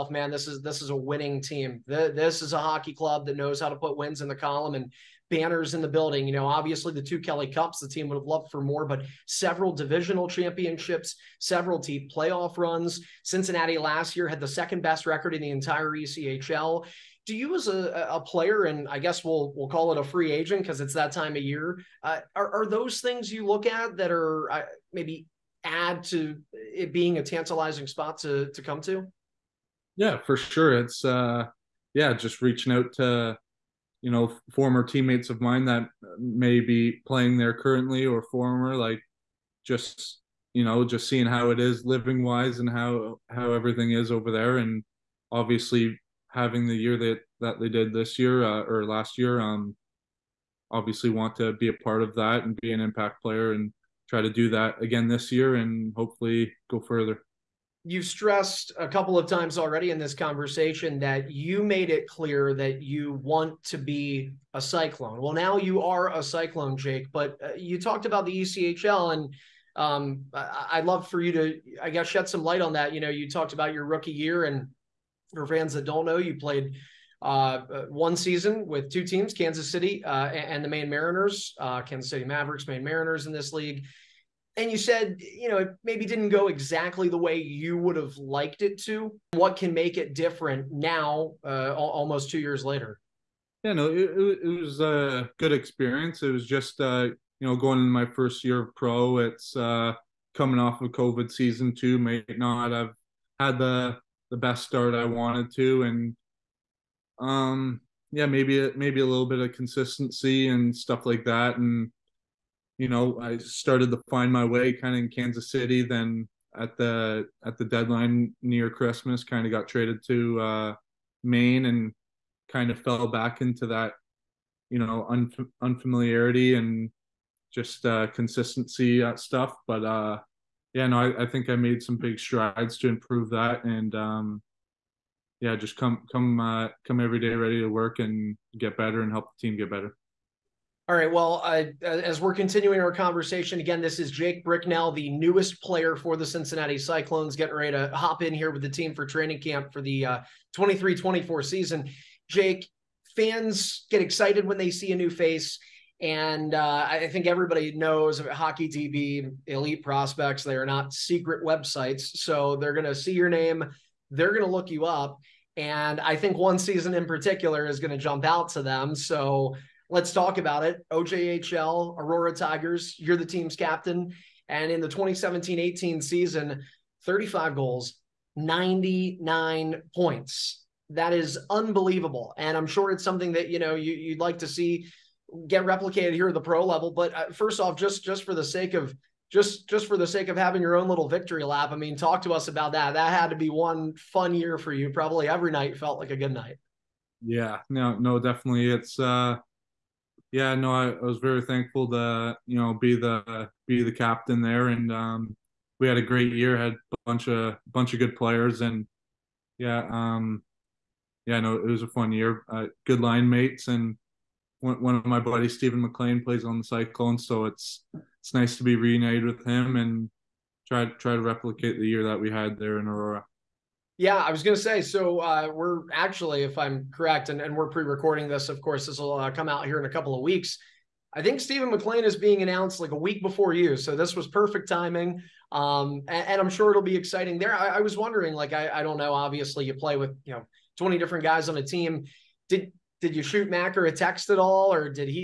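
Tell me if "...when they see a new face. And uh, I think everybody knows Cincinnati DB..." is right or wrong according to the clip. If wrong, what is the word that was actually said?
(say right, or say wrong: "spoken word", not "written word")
wrong: "Hockey", not "Cincinnati".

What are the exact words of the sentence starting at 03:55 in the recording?
Um, and, and, I'm sure it'll be exciting there.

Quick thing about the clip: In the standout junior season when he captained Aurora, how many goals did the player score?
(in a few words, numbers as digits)
35.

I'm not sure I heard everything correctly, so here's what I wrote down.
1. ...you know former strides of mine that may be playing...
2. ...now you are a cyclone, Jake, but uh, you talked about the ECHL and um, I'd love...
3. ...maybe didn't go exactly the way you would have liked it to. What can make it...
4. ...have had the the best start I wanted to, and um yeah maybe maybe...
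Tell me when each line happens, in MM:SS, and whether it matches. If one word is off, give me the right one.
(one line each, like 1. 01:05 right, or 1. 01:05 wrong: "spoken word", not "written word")
1. 00:34 wrong: "teammates", not "strides"
2. 01:05 right
3. 01:25 right
4. 01:42 right.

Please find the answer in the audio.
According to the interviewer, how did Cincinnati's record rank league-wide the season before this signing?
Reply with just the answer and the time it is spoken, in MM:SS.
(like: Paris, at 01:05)
Second best, at 00:14.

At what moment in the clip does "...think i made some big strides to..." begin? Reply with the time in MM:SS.
02:11.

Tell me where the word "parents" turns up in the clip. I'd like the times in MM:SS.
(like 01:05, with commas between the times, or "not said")
not said.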